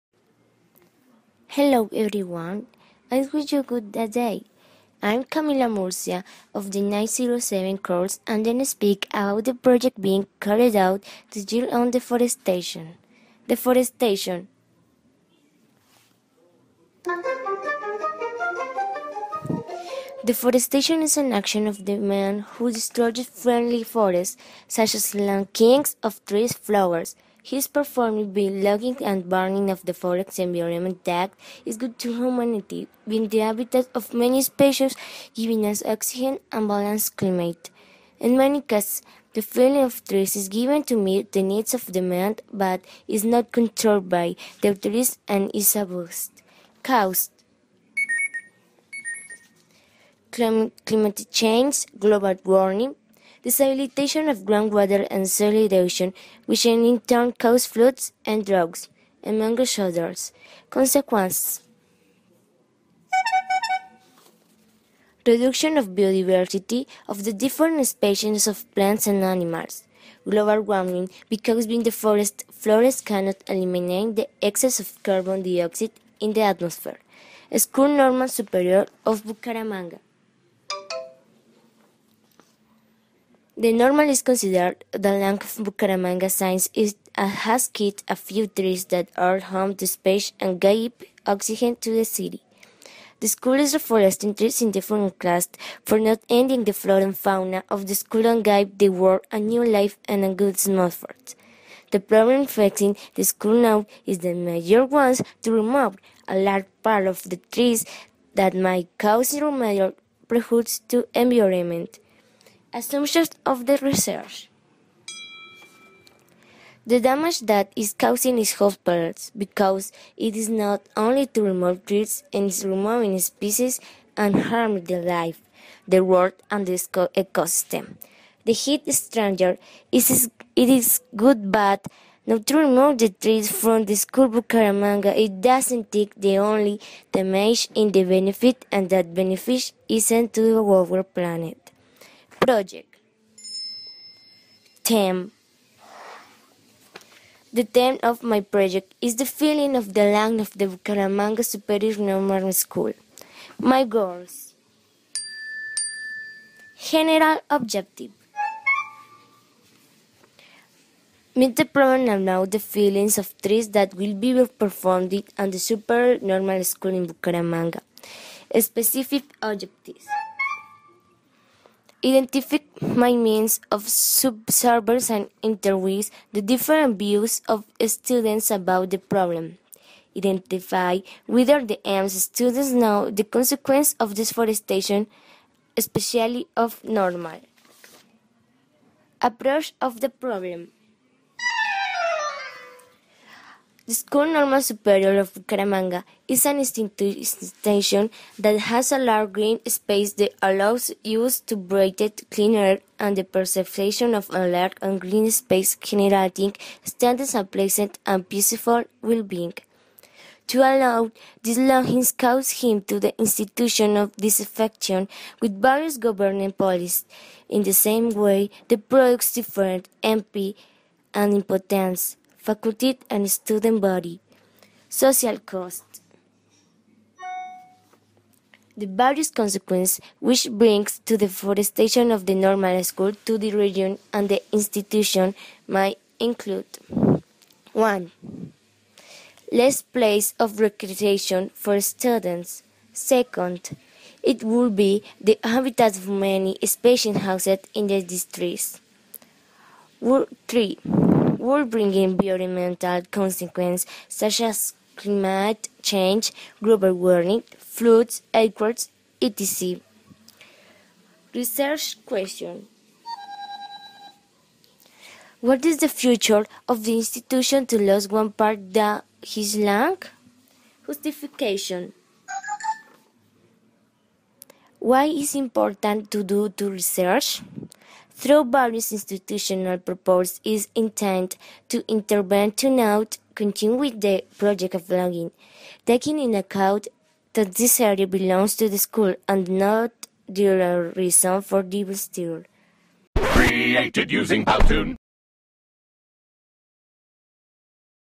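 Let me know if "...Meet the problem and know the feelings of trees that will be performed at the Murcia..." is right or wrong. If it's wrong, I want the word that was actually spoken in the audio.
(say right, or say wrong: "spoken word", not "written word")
wrong: "Super", not "Murcia".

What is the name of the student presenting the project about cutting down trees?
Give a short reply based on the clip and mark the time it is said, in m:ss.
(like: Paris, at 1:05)
Camila Murcia, at 0:05.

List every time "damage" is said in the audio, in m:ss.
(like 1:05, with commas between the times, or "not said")
1:57, 2:17.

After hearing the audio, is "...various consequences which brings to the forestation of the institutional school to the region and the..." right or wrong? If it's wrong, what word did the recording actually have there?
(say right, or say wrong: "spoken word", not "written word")
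wrong: "normal", not "institutional".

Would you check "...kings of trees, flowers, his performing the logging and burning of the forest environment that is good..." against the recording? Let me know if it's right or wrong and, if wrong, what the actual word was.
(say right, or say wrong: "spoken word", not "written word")
right.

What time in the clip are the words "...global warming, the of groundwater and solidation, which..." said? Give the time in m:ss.
0:51.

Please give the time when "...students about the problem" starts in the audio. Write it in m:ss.
2:57.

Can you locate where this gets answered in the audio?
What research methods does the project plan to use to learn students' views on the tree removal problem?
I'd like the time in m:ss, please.
2:53.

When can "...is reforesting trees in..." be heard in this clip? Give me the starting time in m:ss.
1:33.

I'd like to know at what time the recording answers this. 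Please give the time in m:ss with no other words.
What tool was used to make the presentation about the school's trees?
4:54.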